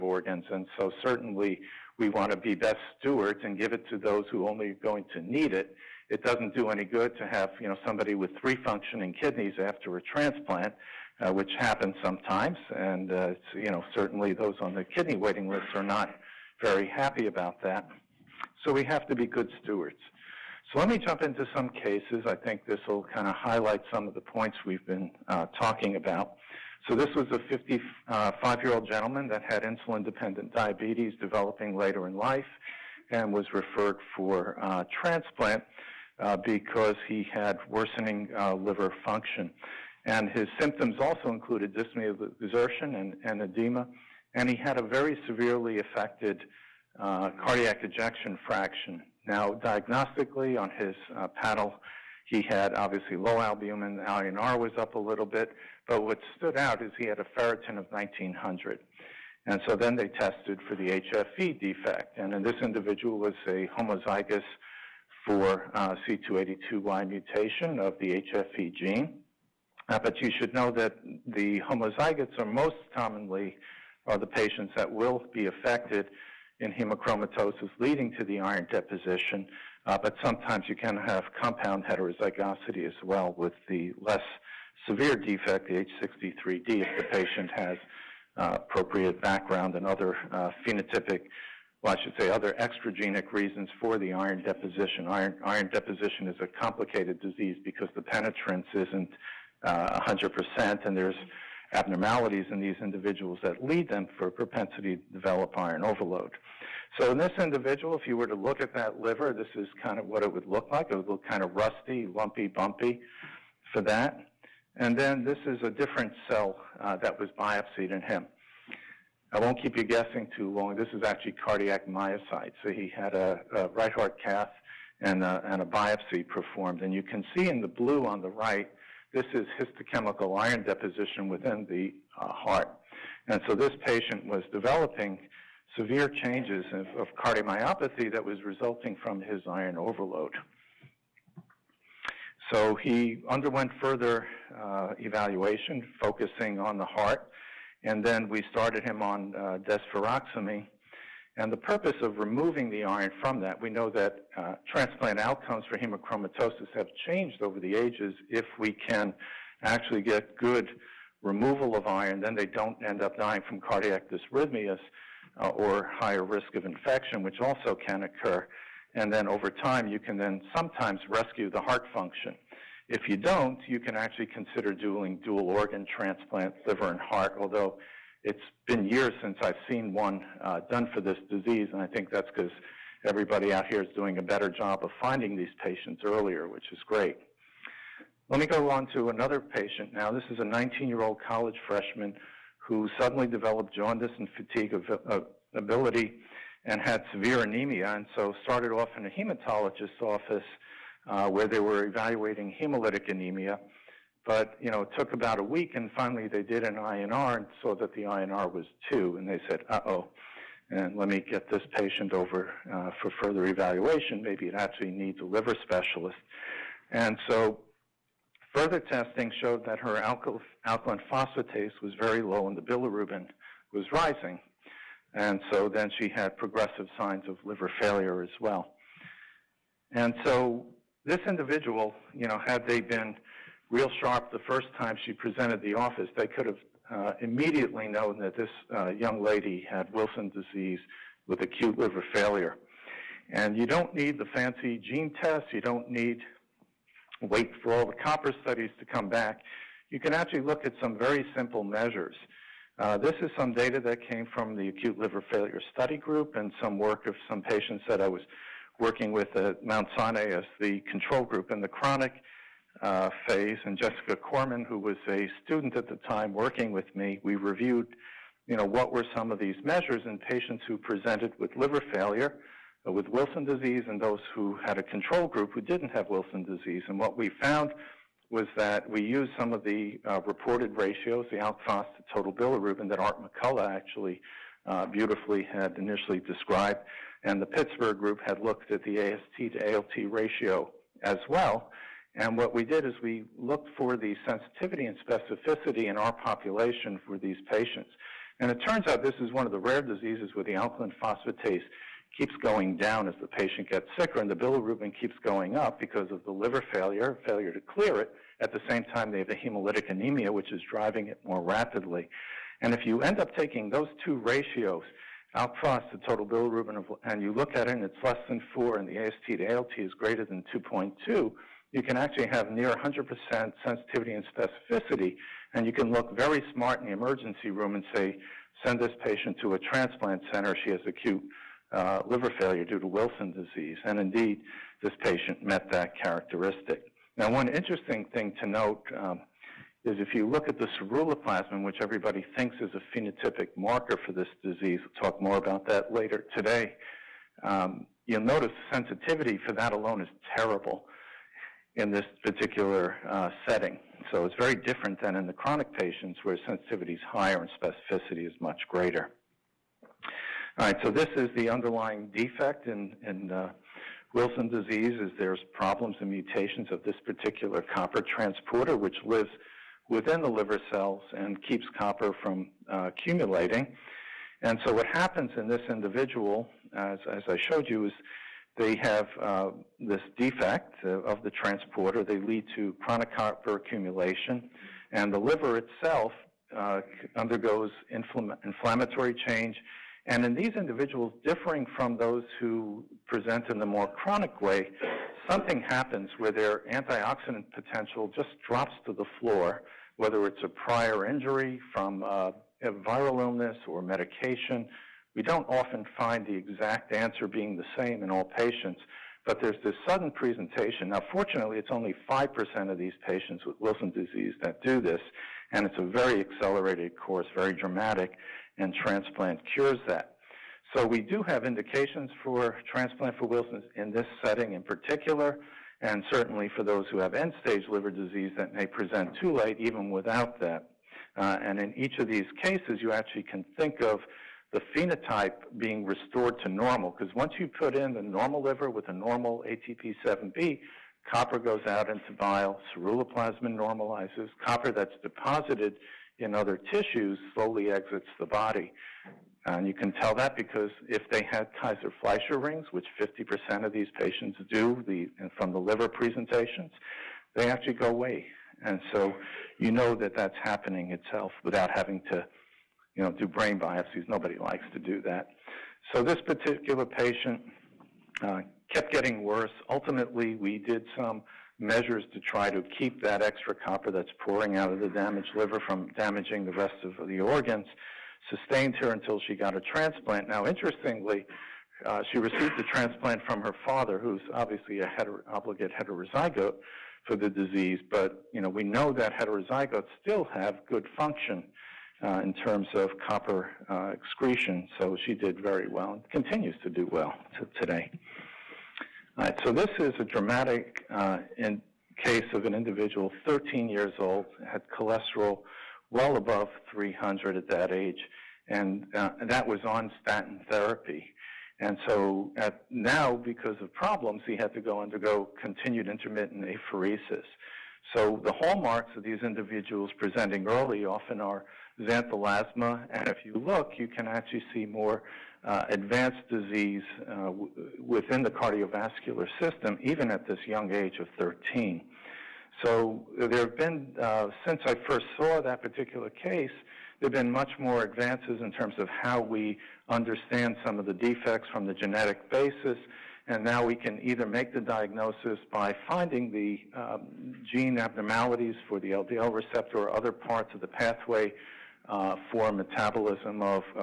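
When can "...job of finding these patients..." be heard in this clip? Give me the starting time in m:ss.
3:04.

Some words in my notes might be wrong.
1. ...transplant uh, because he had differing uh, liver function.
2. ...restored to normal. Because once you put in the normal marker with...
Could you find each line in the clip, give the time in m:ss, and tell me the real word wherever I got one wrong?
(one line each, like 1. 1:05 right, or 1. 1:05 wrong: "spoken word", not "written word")
1. 0:35 wrong: "worsening", not "differing"
2. 7:15 wrong: "liver", not "marker".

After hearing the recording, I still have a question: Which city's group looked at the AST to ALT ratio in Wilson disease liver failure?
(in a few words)
Pittsburgh.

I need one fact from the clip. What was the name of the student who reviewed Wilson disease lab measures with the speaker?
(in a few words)
Jessica Corman.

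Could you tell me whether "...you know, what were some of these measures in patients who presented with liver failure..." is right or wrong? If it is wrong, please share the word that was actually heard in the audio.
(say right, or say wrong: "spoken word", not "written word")
right.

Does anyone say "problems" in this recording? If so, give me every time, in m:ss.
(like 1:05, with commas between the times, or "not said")
6:05, 8:33.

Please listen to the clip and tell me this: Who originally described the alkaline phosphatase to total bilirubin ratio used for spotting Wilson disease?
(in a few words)
Art McCullough.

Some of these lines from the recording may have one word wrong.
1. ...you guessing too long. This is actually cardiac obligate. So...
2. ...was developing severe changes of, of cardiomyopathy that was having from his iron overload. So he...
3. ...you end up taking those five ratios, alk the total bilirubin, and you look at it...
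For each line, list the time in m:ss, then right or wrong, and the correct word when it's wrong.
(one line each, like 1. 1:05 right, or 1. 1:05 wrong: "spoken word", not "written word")
1. 1:59 wrong: "myocyte", not "obligate"
2. 2:14 wrong: "resulting", not "having"
3. 5:12 wrong: "two", not "five".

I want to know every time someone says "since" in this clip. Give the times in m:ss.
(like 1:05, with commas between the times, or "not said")
2:59, 8:54.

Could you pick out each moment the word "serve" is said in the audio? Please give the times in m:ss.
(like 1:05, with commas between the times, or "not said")
not said.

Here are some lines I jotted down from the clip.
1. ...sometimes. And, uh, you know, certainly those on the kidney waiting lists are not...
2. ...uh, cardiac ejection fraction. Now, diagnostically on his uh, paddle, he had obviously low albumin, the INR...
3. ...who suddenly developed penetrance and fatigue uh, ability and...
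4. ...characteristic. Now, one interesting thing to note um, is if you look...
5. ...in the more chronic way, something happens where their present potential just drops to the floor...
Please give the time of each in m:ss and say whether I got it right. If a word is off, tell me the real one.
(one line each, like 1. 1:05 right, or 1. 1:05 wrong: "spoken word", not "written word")
1. 0:12 right
2. 0:46 right
3. 3:12 wrong: "jaundice", not "penetrance"
4. 5:36 right
5. 6:33 wrong: "antioxidant", not "present".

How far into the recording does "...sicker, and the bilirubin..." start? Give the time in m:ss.
5:03.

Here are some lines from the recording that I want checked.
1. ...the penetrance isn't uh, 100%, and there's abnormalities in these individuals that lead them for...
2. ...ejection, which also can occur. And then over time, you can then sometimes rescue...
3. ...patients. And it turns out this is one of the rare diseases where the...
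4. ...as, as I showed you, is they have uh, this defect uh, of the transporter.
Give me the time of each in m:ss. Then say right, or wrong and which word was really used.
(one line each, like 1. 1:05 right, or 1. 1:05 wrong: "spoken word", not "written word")
1. 1:37 right
2. 2:46 wrong: "infection", not "ejection"
3. 4:57 right
4. 6:16 right.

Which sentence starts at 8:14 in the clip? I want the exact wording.
So she did very well and continues to do well to today.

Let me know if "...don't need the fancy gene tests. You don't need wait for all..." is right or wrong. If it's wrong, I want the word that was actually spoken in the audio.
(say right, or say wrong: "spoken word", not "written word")
right.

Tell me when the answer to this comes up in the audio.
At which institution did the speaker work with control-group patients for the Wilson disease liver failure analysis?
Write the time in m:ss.
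4:19.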